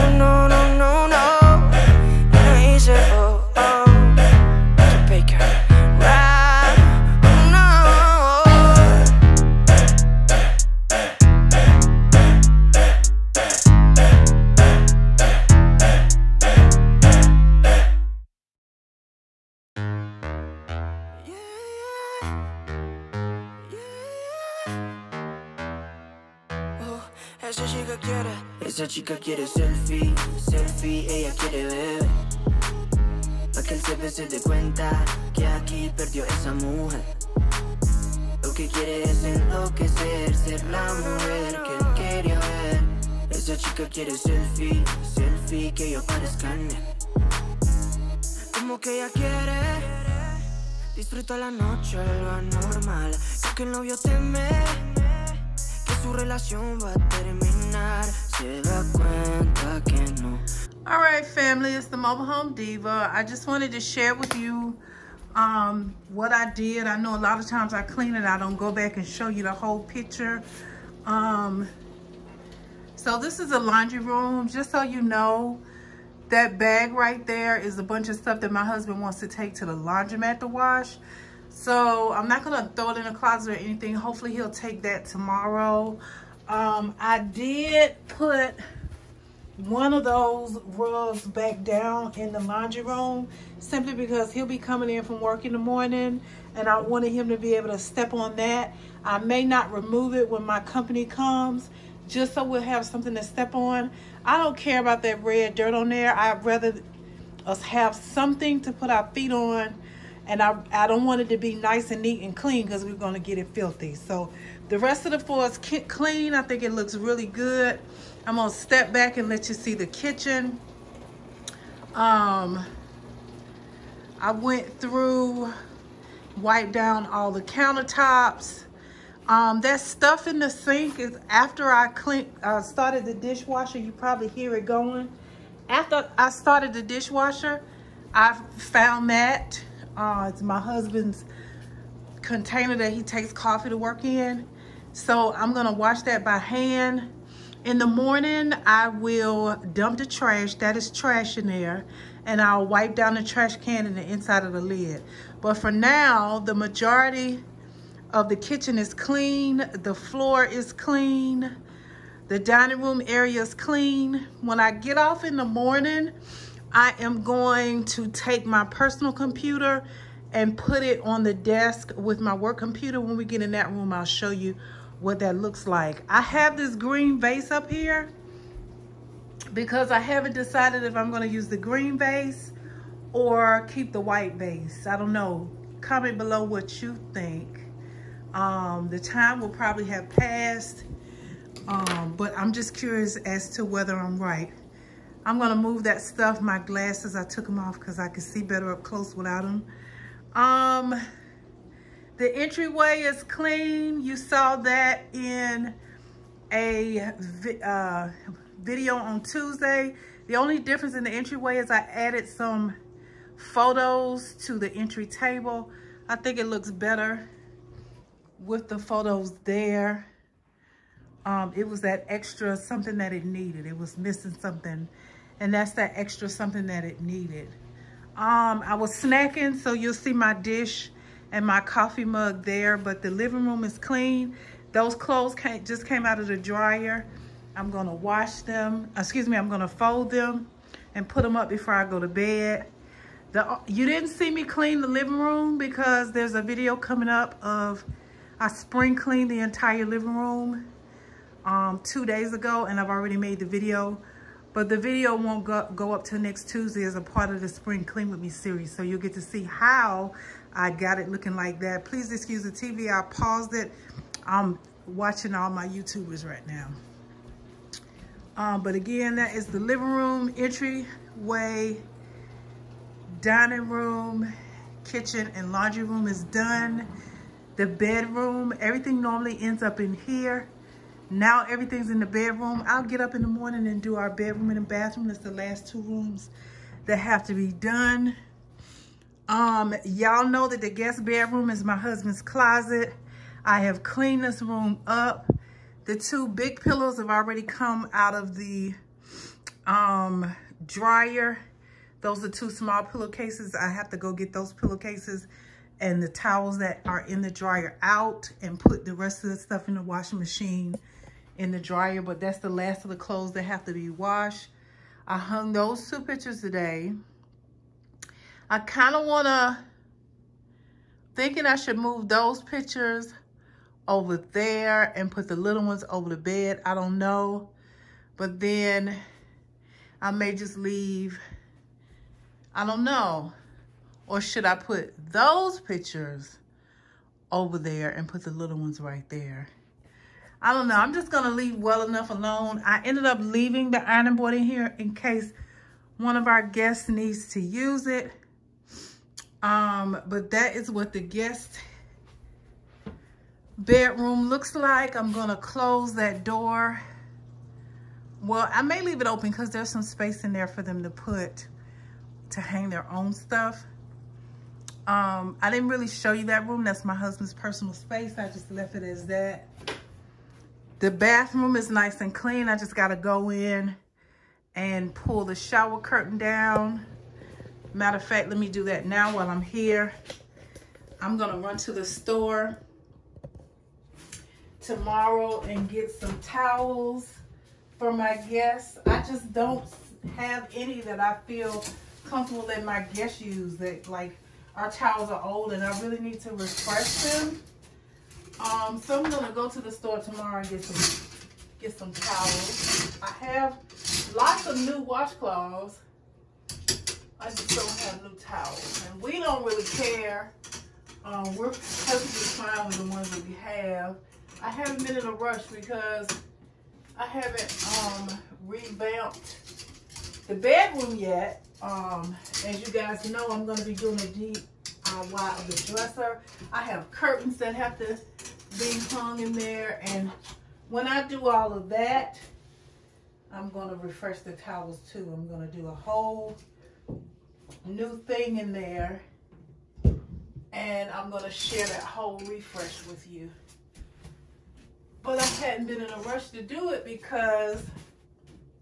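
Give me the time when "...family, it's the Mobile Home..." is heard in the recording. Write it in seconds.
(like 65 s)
61 s.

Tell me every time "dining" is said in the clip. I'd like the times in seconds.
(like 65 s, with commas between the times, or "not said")
162 s, 273 s.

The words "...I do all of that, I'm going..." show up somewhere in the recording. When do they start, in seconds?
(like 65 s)
430 s.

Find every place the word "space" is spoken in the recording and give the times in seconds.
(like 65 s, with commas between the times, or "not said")
359 s, 367 s.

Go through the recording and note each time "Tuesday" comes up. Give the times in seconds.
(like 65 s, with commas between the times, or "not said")
209 s, 256 s.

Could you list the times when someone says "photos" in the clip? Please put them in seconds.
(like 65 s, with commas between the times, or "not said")
213 s, 218 s.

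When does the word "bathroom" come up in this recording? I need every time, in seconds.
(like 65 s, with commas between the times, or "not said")
284 s, 370 s.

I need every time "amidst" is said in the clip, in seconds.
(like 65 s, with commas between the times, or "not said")
not said.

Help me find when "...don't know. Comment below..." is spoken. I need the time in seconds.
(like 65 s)
184 s.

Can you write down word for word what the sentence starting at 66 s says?
I know a lot of times I clean it.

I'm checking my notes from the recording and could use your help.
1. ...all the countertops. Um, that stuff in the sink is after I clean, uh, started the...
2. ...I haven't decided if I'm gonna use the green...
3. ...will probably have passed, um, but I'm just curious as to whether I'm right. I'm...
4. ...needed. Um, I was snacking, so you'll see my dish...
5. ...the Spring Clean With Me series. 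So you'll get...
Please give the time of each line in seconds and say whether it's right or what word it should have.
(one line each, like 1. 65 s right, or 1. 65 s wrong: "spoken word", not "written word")
1. 127 s right
2. 179 s right
3. 189 s right
4. 227 s right
5. 257 s right.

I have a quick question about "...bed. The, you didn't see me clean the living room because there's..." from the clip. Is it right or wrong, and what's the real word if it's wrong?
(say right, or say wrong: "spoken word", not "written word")
right.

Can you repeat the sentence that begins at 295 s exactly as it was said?
The two big pillows have already come out of the um, dryer.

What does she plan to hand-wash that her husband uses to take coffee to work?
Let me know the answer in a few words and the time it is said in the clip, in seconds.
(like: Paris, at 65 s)
Container, at 142 s.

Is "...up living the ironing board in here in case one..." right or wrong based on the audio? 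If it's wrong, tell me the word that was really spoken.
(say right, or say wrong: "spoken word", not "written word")
wrong: "leaving", not "living".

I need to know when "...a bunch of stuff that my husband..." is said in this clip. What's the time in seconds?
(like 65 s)
77 s.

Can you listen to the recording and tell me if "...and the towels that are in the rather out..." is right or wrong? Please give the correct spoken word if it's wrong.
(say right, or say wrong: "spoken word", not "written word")
wrong: "dryer", not "rather".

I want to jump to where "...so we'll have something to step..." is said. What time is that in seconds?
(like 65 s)
102 s.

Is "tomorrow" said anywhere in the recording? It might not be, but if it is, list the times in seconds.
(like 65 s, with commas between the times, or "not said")
85 s, 384 s, 399 s.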